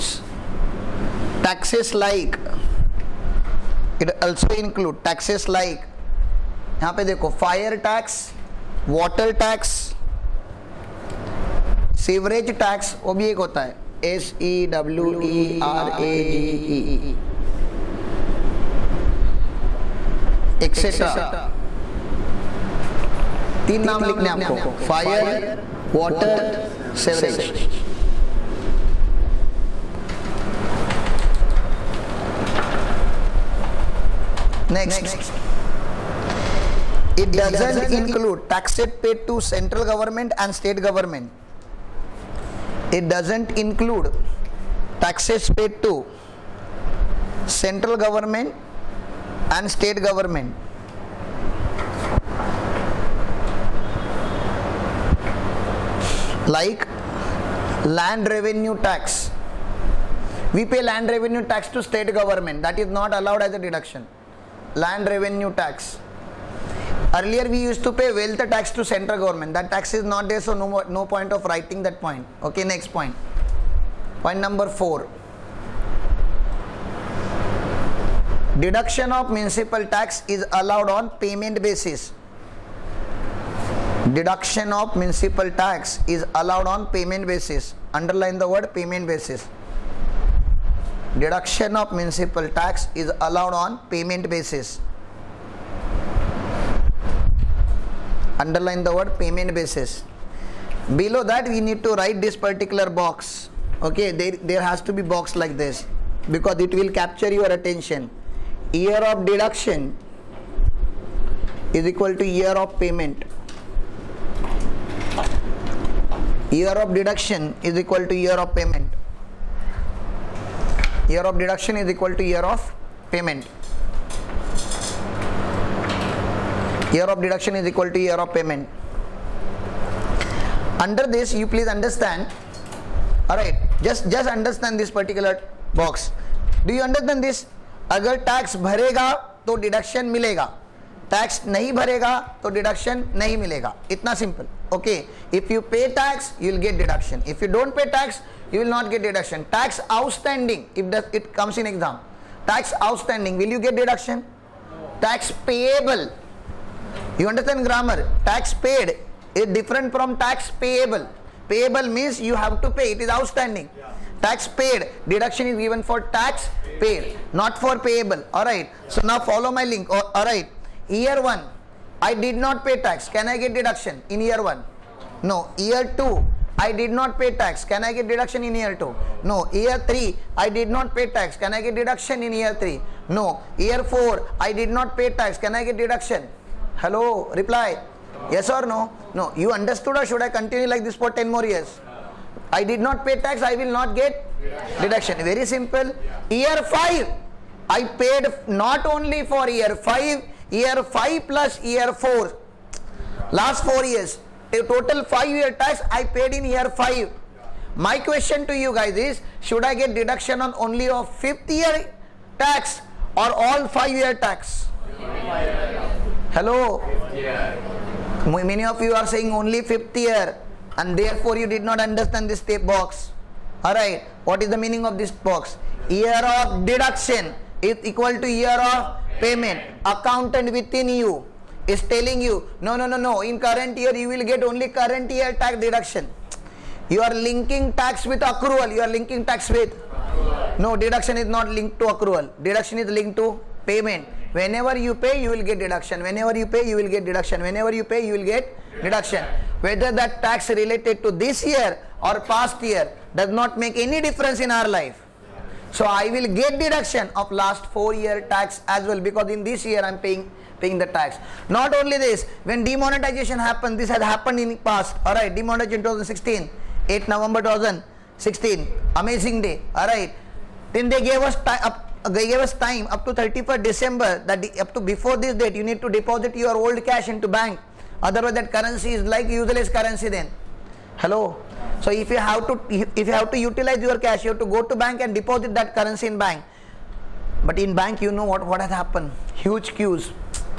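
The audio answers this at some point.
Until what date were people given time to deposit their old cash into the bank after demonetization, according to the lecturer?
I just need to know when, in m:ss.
4:33.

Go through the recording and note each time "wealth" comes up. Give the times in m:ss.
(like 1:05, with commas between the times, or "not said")
1:08.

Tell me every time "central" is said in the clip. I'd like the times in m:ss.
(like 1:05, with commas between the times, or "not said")
0:39, 0:47, 1:08.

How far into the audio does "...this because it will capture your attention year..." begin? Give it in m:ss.
1:45.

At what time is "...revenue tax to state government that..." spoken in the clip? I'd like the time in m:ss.
1:01.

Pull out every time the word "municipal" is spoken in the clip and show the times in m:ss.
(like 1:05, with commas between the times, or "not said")
1:19, 1:24, 1:31.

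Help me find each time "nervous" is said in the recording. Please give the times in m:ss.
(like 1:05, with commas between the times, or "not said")
not said.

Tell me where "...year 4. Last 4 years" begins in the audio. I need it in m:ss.
3:21.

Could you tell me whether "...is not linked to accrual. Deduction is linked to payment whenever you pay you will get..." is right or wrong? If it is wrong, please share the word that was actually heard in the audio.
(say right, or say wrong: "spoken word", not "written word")
right.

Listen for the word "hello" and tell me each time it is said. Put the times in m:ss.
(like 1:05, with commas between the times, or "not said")
3:06, 3:36, 4:40.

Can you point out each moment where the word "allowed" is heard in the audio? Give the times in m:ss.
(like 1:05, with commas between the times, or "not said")
1:03, 1:20, 1:26, 1:33.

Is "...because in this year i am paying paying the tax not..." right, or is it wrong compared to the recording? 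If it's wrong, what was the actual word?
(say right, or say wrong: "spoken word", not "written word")
right.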